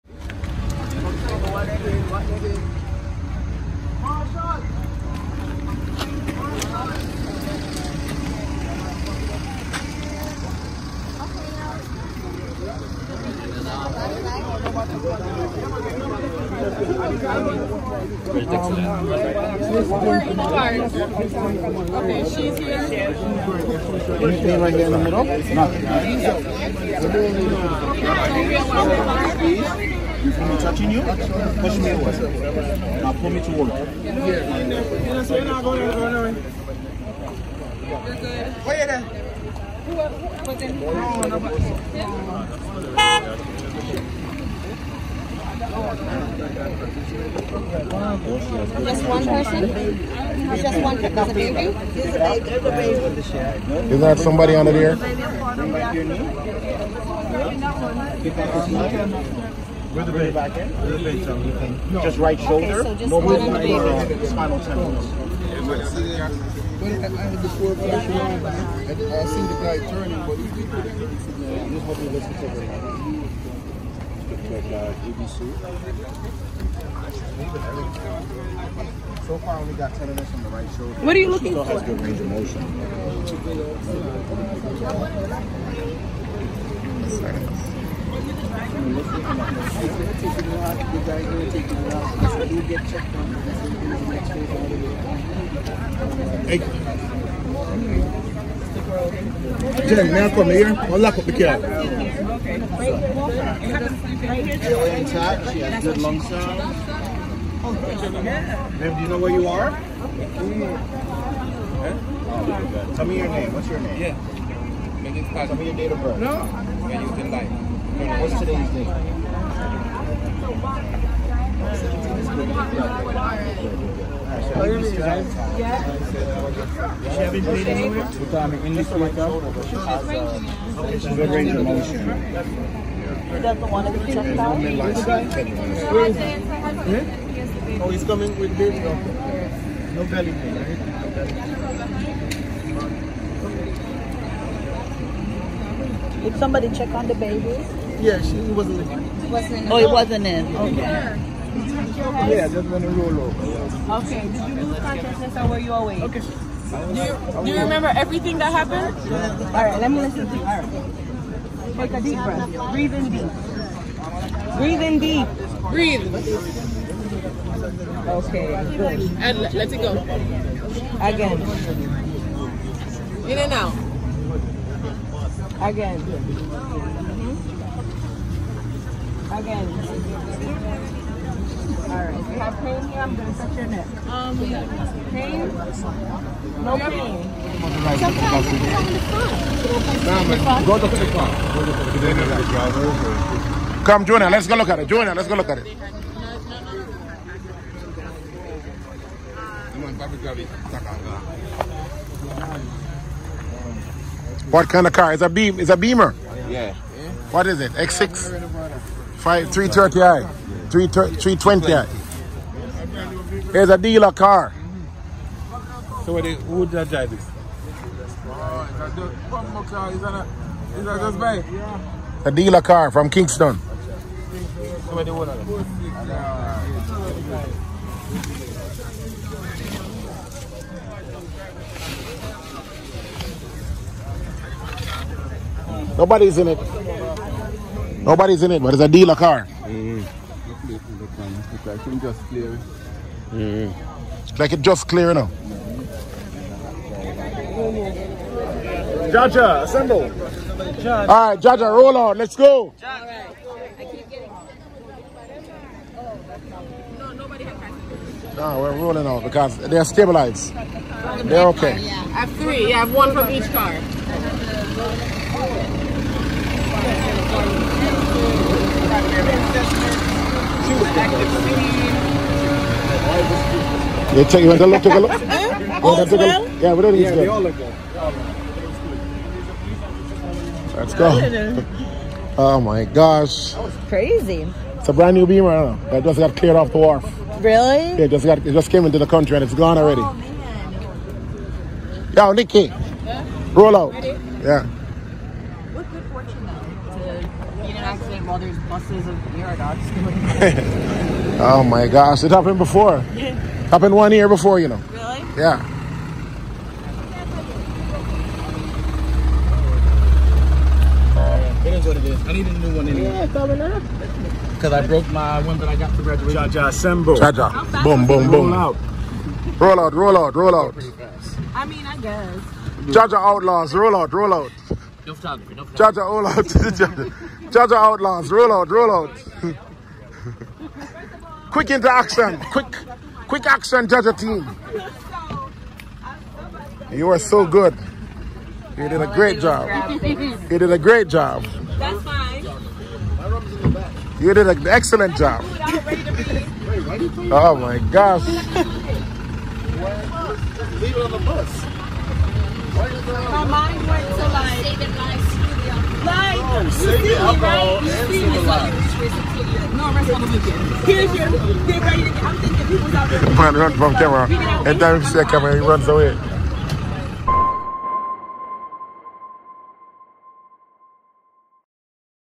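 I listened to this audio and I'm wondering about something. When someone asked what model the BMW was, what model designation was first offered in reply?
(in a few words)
X6.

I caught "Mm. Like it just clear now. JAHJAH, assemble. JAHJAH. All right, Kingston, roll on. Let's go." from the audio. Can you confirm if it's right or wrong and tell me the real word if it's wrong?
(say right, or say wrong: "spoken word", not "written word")
wrong: "JAHJAH", not "Kingston".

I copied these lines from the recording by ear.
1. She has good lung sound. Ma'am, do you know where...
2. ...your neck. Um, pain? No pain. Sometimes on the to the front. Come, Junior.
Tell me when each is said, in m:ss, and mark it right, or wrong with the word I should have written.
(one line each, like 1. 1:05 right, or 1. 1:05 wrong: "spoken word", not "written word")
1. 1:45 right
2. 3:03 right.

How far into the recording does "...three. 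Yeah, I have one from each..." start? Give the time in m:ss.
4:22.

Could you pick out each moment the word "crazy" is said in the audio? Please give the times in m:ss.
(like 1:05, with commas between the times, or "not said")
4:43.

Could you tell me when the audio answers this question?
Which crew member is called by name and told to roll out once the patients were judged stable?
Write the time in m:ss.
4:52.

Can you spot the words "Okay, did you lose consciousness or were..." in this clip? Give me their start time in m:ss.
2:34.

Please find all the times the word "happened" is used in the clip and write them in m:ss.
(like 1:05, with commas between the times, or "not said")
2:38, 5:02.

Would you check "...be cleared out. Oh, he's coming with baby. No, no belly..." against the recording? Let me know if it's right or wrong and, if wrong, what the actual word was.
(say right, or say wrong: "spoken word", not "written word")
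wrong: "checked", not "cleared".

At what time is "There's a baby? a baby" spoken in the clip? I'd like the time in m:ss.
0:49.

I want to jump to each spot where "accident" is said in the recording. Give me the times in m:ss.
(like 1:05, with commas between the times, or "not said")
4:57.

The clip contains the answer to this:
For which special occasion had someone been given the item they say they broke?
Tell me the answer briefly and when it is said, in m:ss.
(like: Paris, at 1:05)
Graduation, at 5:16.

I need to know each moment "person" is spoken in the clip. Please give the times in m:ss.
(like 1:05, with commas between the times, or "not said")
0:40, 0:49.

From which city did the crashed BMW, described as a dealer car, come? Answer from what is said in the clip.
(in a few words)
Kingston.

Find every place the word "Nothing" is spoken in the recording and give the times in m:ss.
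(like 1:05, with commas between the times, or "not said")
0:25.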